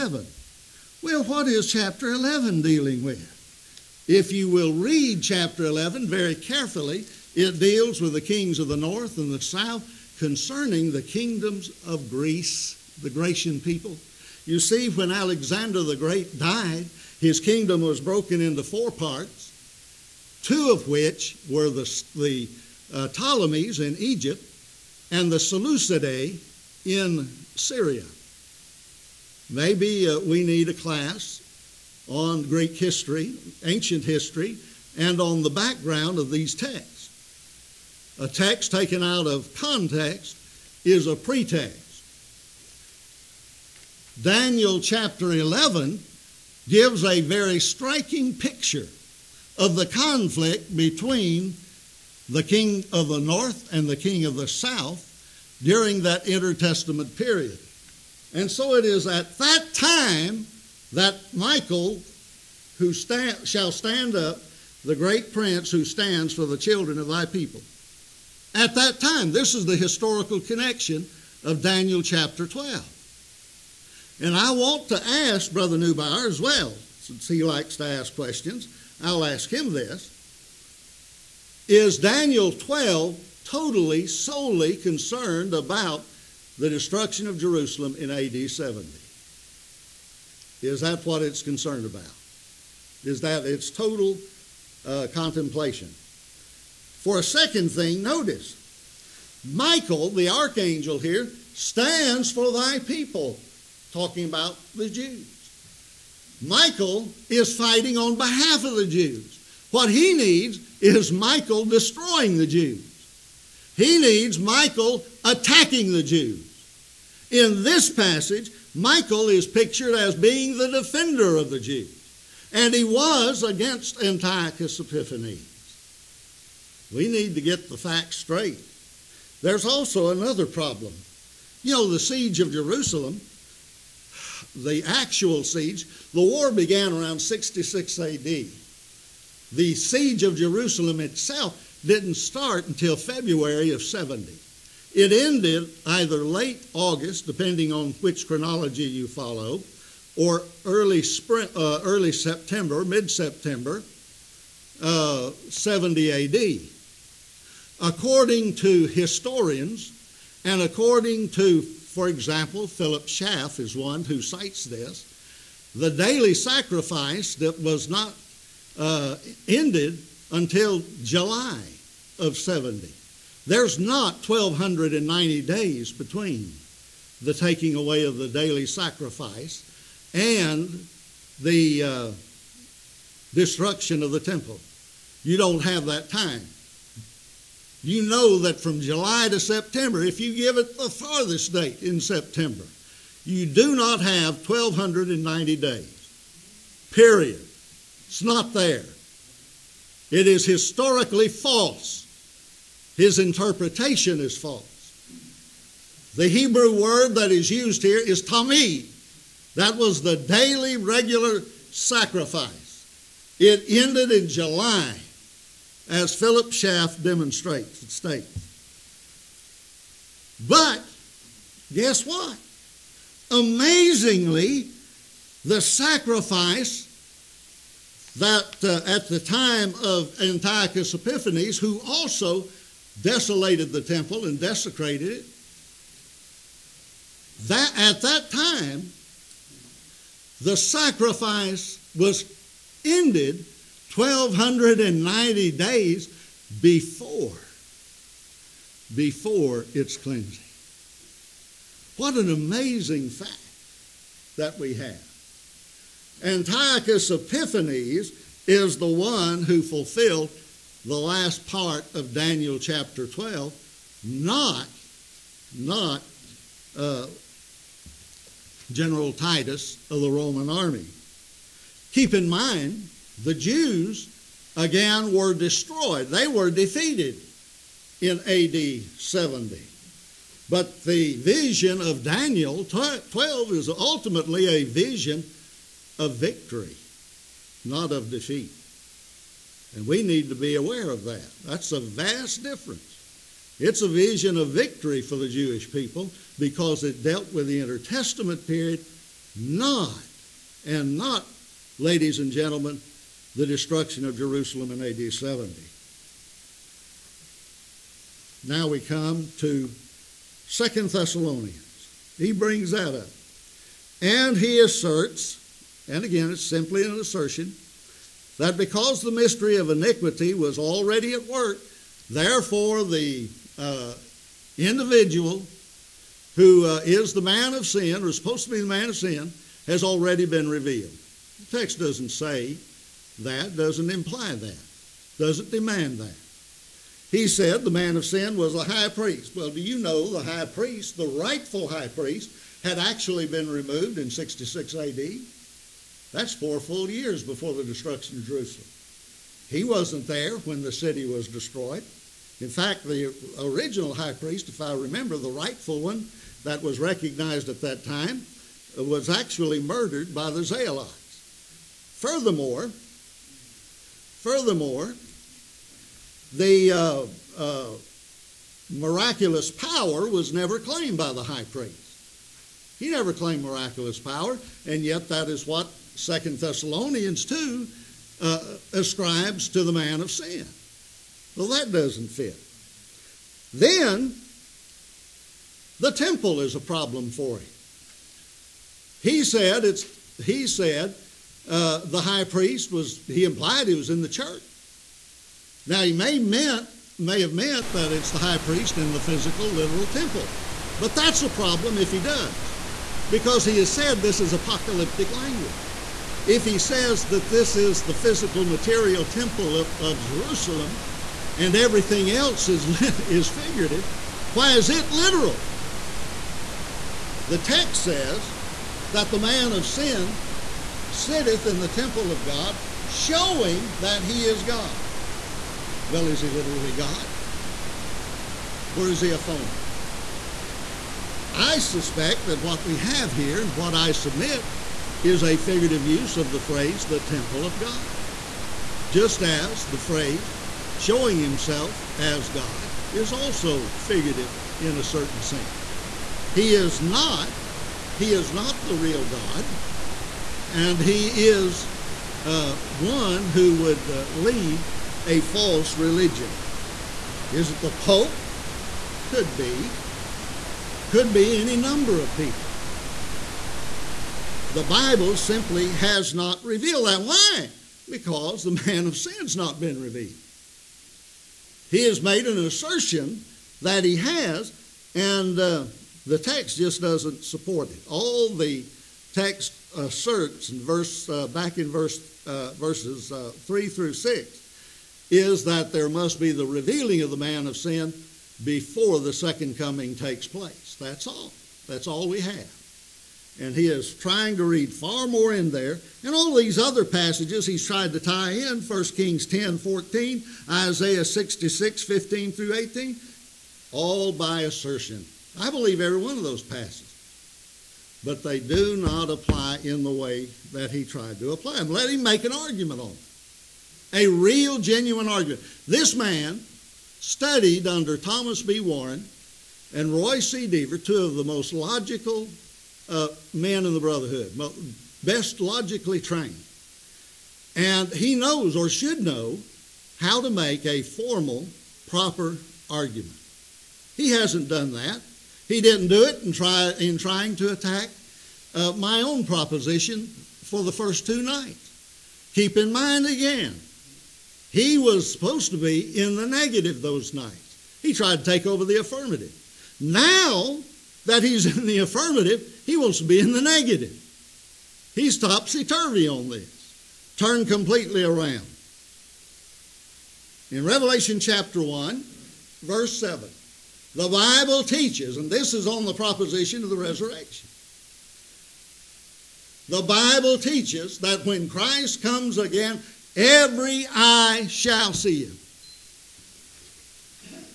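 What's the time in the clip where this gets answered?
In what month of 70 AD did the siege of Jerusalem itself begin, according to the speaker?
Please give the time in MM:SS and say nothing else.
02:22.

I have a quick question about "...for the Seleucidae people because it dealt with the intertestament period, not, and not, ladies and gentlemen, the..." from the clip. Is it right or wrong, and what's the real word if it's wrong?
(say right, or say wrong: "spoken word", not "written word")
wrong: "Jewish", not "Seleucidae".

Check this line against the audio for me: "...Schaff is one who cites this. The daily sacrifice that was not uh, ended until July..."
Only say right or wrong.
right.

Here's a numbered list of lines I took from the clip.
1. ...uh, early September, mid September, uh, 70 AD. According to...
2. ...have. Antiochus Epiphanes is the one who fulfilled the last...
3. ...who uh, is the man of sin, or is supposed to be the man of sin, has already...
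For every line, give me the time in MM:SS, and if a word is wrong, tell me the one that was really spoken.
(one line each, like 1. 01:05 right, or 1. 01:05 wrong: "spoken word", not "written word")
1. 02:31 right
2. 04:14 right
3. 05:26 right.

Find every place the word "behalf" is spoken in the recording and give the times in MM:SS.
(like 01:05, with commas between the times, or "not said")
01:48.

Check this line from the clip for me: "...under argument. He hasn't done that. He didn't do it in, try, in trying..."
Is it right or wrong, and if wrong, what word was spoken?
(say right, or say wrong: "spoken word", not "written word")
wrong: "proper", not "under".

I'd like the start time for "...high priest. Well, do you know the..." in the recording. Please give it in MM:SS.
05:38.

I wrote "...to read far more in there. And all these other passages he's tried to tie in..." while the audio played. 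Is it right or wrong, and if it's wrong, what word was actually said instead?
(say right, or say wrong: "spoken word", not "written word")
right.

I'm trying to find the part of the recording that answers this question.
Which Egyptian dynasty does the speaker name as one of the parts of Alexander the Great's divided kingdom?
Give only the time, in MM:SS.
00:23.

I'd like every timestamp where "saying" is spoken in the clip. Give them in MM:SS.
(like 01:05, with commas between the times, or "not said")
not said.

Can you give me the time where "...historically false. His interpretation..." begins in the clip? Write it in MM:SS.
03:20.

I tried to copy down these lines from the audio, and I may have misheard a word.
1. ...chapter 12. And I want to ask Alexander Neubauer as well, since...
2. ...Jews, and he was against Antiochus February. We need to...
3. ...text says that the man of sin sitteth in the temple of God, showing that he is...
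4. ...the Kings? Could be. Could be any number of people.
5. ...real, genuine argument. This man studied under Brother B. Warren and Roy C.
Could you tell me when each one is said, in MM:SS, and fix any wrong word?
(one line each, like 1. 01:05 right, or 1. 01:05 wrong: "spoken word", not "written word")
1. 01:12 wrong: "Brother", not "Alexander"
2. 02:01 wrong: "Epiphanes", not "February"
3. 06:57 right
4. 07:37 wrong: "Pope", not "Kings"
5. 08:34 wrong: "Thomas", not "Brother".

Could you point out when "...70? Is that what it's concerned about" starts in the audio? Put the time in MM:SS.
01:28.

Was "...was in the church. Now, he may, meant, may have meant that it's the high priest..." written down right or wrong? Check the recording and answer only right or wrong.
right.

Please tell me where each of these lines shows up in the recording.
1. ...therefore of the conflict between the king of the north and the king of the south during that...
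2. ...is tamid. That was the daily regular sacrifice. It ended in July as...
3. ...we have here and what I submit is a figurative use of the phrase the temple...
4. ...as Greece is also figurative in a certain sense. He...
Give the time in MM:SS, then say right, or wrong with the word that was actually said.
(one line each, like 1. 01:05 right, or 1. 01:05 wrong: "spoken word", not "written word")
1. 00:48 wrong: "picture", not "therefore"
2. 03:27 right
3. 07:12 right
4. 07:21 wrong: "God", not "Greece".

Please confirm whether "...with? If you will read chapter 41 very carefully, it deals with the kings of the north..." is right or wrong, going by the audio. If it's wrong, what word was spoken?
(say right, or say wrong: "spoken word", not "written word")
wrong: "11", not "41".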